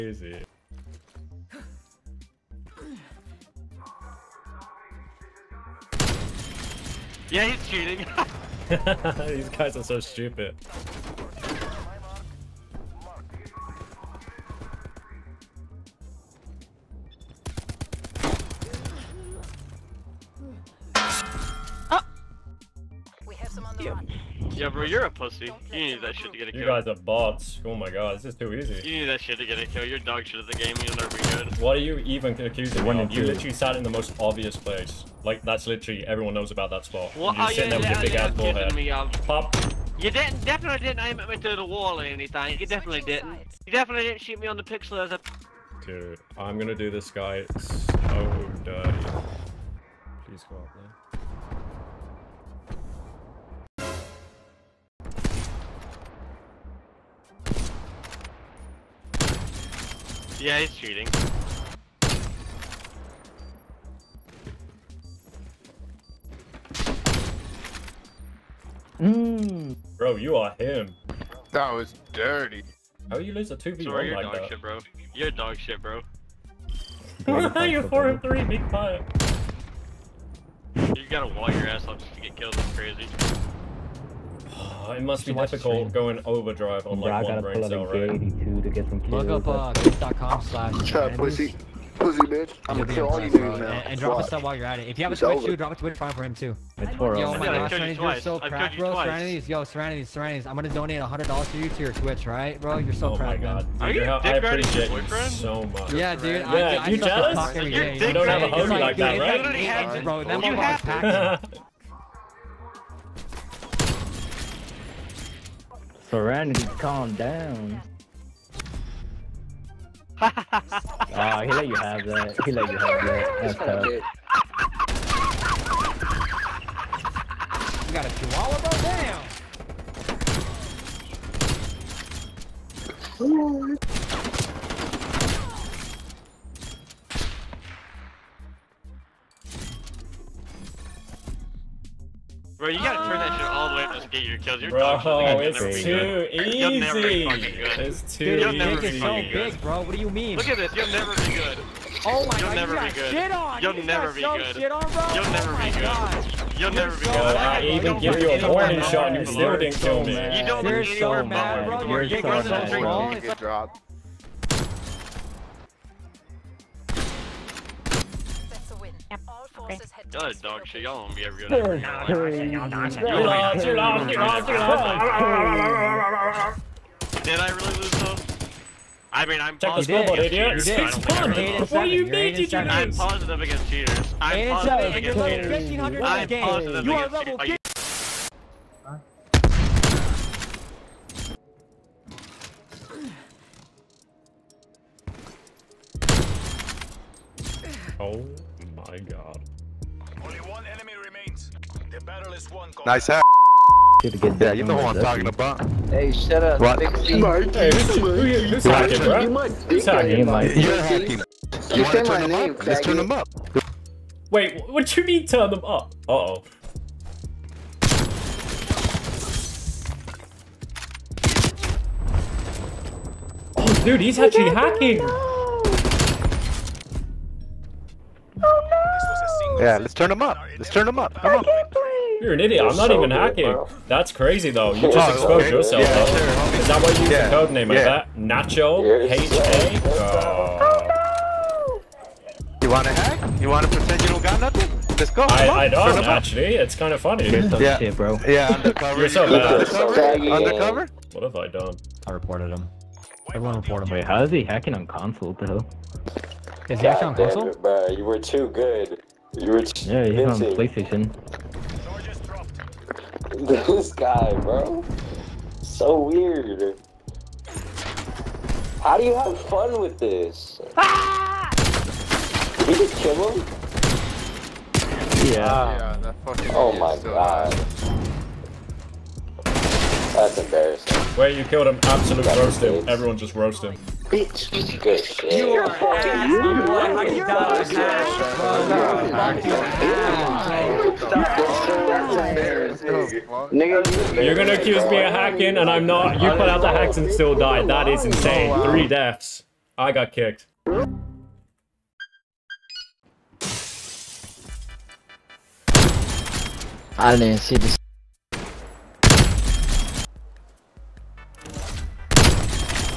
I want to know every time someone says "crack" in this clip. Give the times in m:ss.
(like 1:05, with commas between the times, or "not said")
1:38, 1:43.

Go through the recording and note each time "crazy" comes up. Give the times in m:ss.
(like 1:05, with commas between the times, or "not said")
1:22, 3:54.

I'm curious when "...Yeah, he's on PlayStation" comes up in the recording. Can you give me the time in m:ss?
4:19.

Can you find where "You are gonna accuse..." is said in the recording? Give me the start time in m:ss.
4:53.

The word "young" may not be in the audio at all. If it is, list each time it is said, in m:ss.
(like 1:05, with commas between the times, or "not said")
not said.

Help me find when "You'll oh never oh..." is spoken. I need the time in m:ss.
2:35.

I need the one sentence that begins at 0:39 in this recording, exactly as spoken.
You didn't, definitely didn't aim at me through the wall or anything.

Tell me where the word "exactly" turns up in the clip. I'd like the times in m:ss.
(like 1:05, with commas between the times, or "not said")
not said.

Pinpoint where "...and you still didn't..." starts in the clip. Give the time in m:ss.
2:39.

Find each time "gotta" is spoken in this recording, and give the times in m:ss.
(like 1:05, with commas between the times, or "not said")
1:21, 2:22.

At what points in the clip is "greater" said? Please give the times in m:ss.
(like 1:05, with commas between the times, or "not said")
not said.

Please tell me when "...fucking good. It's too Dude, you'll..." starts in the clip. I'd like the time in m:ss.
2:27.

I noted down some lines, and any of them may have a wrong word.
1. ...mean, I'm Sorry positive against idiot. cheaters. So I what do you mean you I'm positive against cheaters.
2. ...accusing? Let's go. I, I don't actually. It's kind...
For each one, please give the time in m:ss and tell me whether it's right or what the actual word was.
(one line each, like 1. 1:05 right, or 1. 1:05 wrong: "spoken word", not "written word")
1. 2:59 wrong: "Check", not "Sorry"
2. 4:04 wrong: "nothing", not "accusing".